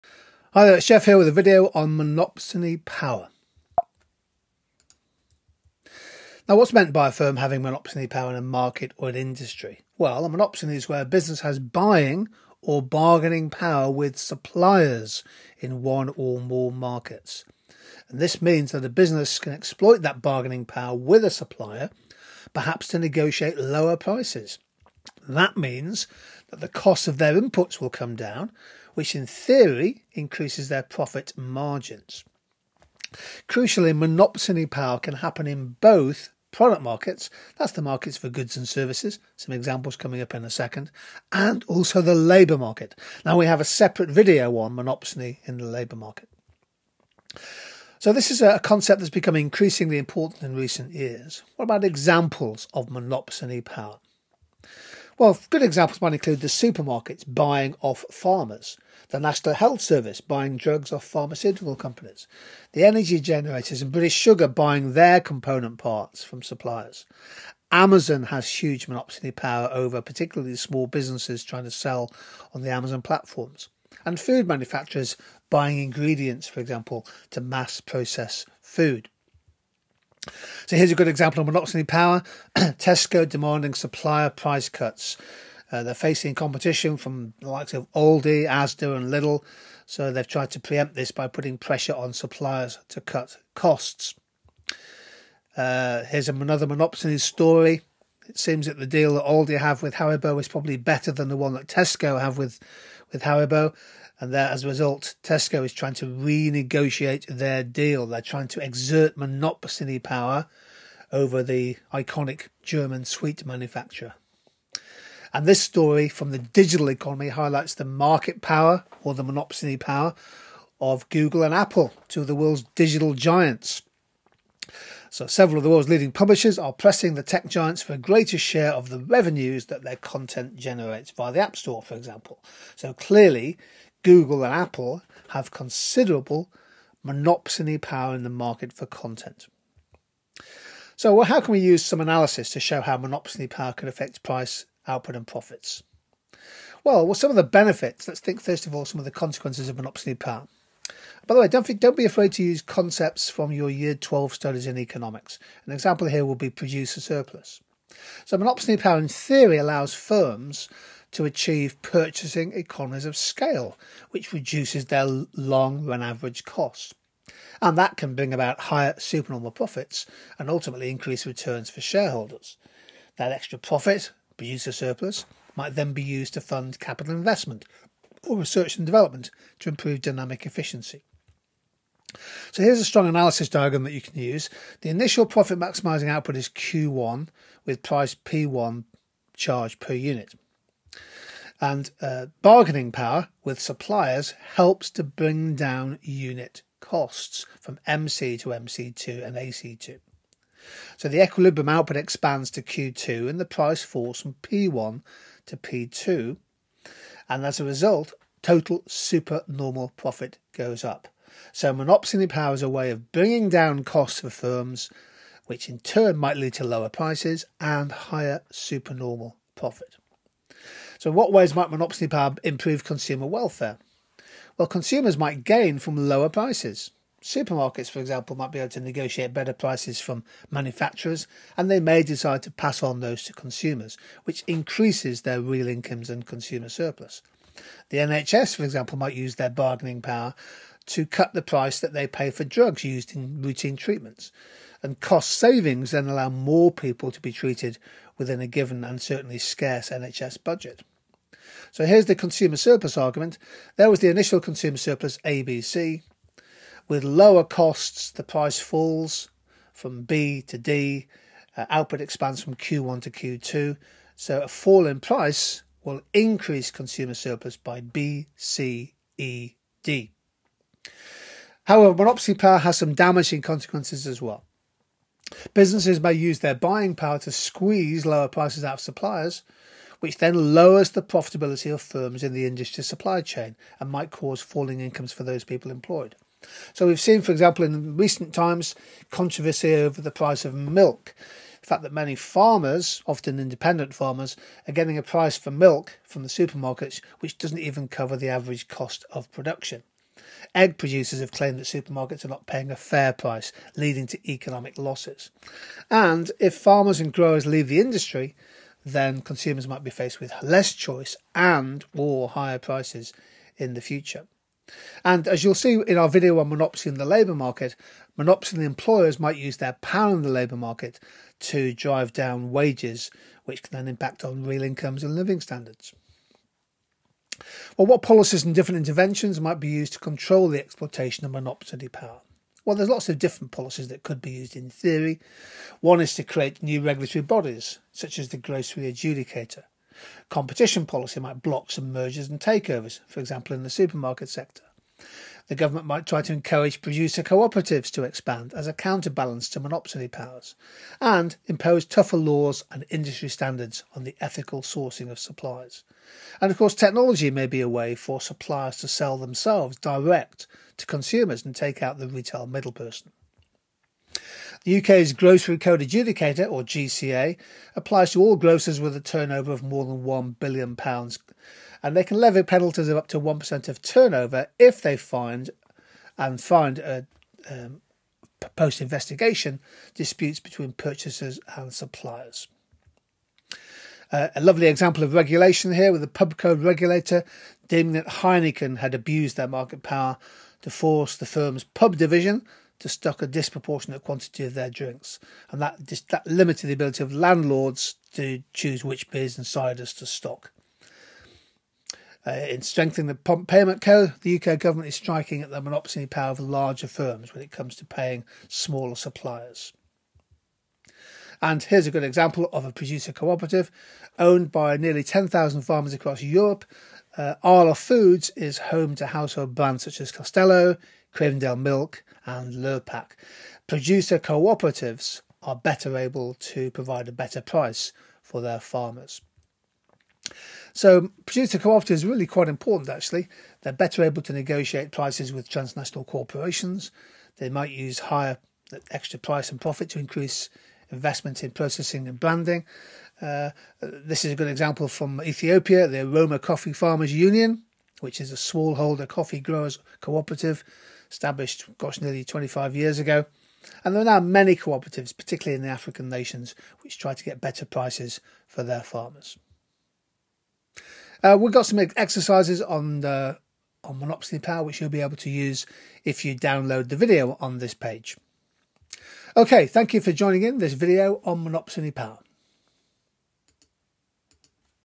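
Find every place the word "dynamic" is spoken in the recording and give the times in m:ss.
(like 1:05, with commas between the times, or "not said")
3:00.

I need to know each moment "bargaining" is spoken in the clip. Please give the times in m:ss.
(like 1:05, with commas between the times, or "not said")
0:12, 0:20, 3:12, 3:59.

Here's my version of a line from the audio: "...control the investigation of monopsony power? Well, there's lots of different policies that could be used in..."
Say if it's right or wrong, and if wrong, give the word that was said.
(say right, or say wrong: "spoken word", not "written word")
wrong: "exploitation", not "investigation".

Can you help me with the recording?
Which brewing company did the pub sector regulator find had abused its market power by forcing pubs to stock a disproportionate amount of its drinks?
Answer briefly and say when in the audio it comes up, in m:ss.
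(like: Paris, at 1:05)
Heineken, at 6:28.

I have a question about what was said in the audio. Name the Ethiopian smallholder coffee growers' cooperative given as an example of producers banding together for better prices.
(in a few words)
Oromia Coffee Farmers Union.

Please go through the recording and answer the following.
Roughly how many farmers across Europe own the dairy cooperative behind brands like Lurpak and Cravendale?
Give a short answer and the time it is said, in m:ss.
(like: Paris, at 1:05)
10,000, at 6:55.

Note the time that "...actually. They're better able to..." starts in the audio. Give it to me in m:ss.
7:12.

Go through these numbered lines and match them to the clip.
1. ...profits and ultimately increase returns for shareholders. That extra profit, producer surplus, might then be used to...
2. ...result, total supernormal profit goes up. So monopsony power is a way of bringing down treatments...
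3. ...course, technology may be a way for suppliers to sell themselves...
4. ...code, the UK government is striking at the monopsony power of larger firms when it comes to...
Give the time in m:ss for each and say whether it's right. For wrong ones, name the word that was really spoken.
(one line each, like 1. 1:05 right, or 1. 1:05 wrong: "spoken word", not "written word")
1. 2:49 right
2. 3:27 wrong: "costs", not "treatments"
3. 5:56 right
4. 6:43 right.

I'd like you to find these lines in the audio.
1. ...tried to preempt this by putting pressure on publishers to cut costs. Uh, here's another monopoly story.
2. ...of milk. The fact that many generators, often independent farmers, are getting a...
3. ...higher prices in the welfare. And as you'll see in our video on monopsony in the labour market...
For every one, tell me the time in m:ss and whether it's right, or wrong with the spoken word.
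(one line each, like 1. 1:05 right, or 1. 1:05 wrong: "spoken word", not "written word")
1. 1:30 wrong: "suppliers", not "publishers"
2. 4:50 wrong: "farmers", not "generators"
3. 5:12 wrong: "future", not "welfare".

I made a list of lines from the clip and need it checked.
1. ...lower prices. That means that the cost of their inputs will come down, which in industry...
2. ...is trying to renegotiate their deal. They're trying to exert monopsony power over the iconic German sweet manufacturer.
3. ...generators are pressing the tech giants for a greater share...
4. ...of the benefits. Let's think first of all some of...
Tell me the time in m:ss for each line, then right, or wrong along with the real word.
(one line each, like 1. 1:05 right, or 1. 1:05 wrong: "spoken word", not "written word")
1. 0:23 wrong: "theory", not "industry"
2. 1:45 right
3. 2:06 wrong: "publishers", not "generators"
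4. 2:27 right.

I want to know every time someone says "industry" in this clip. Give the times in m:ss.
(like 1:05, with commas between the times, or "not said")
0:09, 4:42, 5:07, 5:52.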